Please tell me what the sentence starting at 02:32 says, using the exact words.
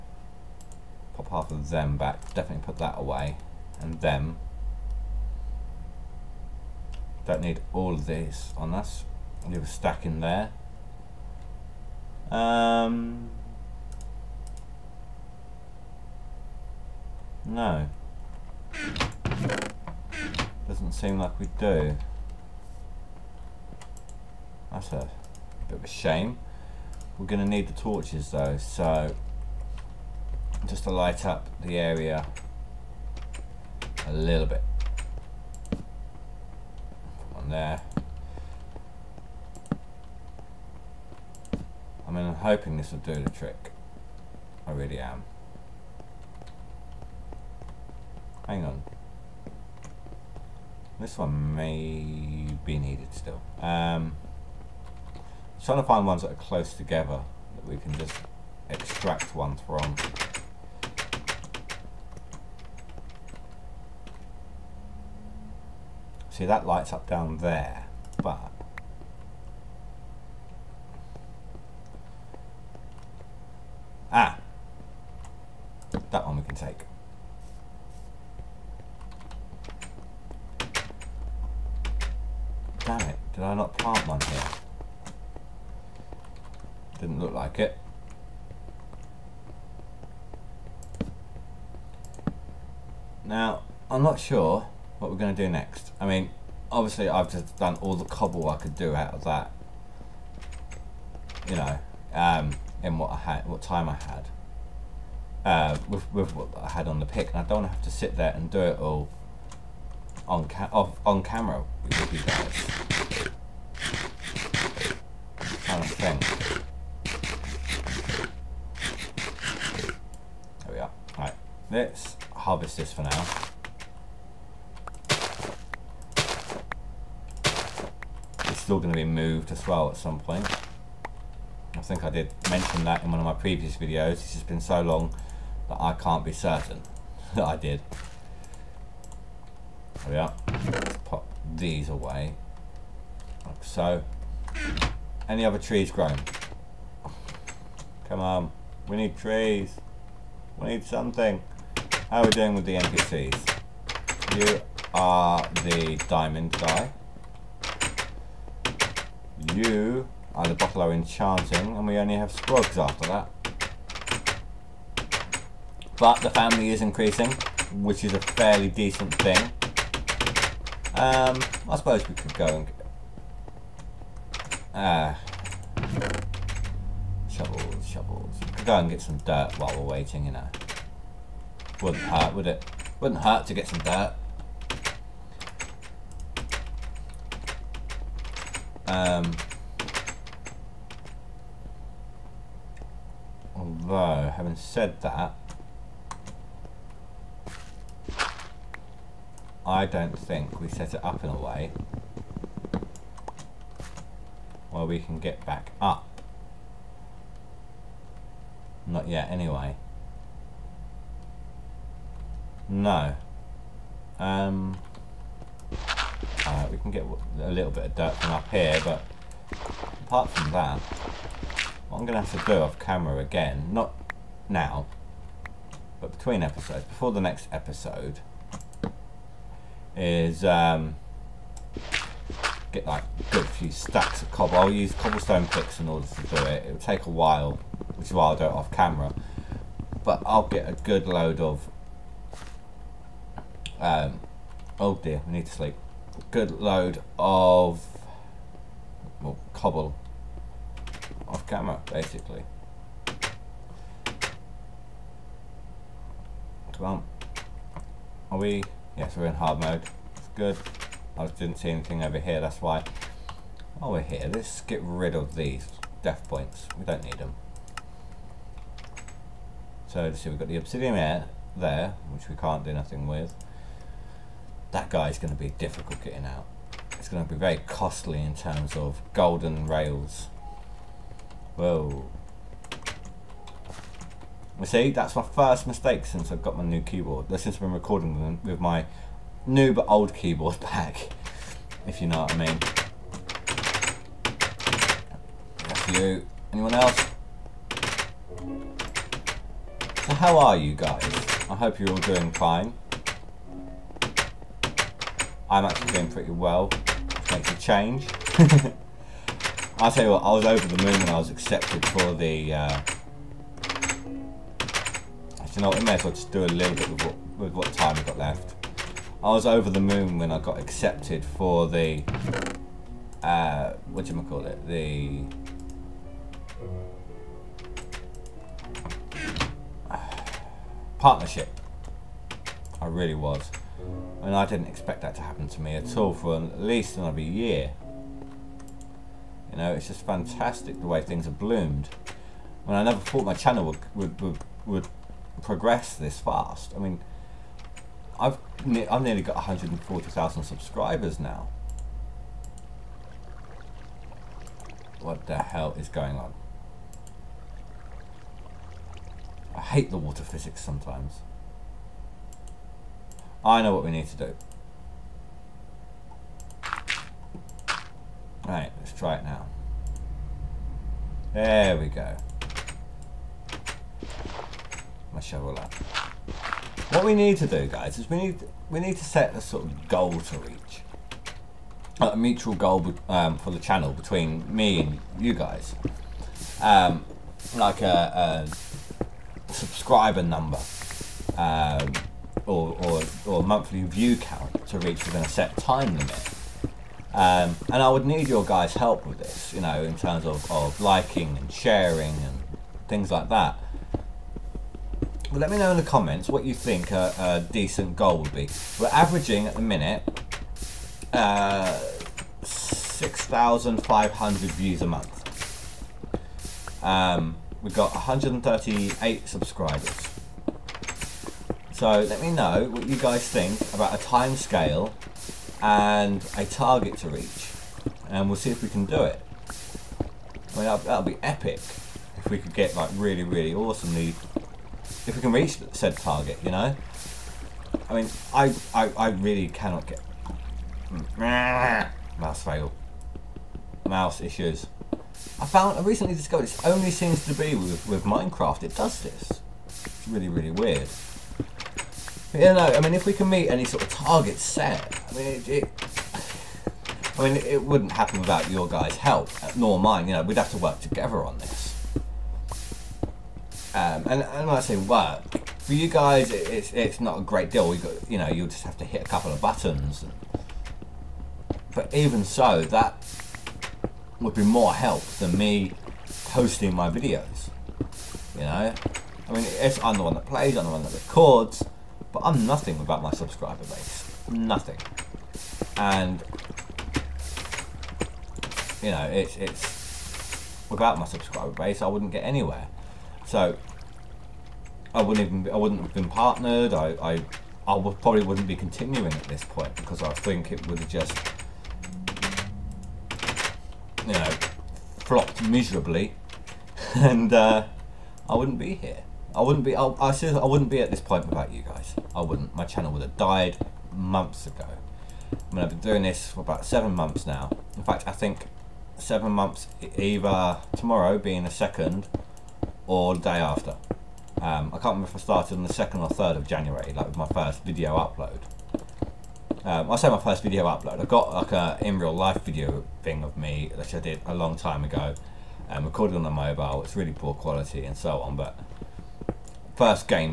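How are we doing with the NPCs?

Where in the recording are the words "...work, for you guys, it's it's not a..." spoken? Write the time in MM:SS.
07:44.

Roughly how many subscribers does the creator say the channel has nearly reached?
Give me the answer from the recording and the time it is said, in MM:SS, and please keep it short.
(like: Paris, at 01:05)
140,000, at 05:49.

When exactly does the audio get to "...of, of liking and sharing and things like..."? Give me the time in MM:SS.
06:40.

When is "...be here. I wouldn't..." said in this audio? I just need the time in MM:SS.
08:28.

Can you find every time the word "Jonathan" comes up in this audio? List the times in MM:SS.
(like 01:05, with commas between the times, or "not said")
not said.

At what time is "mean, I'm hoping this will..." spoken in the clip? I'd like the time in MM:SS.
00:42.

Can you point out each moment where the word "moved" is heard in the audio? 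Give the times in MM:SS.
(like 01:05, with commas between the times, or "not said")
02:09.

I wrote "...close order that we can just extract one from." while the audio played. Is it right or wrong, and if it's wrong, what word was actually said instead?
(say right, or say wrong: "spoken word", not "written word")
wrong: "together", not "order".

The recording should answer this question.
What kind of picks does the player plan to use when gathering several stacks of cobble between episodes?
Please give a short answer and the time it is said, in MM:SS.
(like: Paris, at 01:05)
cobblestone picks, at 03:54.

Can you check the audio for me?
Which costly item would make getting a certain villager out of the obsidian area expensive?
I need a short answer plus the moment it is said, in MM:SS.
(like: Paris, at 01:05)
golden rails, at 04:39.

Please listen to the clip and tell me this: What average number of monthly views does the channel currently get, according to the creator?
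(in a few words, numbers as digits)
6,500.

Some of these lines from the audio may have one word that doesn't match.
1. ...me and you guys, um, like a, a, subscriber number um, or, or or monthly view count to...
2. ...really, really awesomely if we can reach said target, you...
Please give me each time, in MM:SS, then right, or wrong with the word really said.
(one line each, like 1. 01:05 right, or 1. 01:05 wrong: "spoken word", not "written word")
1. 06:24 right
2. 07:12 right.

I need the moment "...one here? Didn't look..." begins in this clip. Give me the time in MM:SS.
01:24.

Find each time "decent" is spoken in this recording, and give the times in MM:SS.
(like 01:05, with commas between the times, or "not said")
02:48, 06:47.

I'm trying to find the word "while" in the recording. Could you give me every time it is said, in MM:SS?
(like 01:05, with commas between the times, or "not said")
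02:59, 03:57, 04:23.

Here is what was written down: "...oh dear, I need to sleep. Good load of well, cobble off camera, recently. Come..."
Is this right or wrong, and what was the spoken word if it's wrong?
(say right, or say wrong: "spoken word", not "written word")
wrong: "basically", not "recently".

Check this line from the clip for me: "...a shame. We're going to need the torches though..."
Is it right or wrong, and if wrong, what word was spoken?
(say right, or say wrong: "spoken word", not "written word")
right.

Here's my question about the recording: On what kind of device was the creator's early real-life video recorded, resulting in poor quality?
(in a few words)
a mobile.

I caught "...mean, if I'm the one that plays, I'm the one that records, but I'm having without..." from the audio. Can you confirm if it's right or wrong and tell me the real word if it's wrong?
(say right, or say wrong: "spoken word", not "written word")
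wrong: "nothing", not "having".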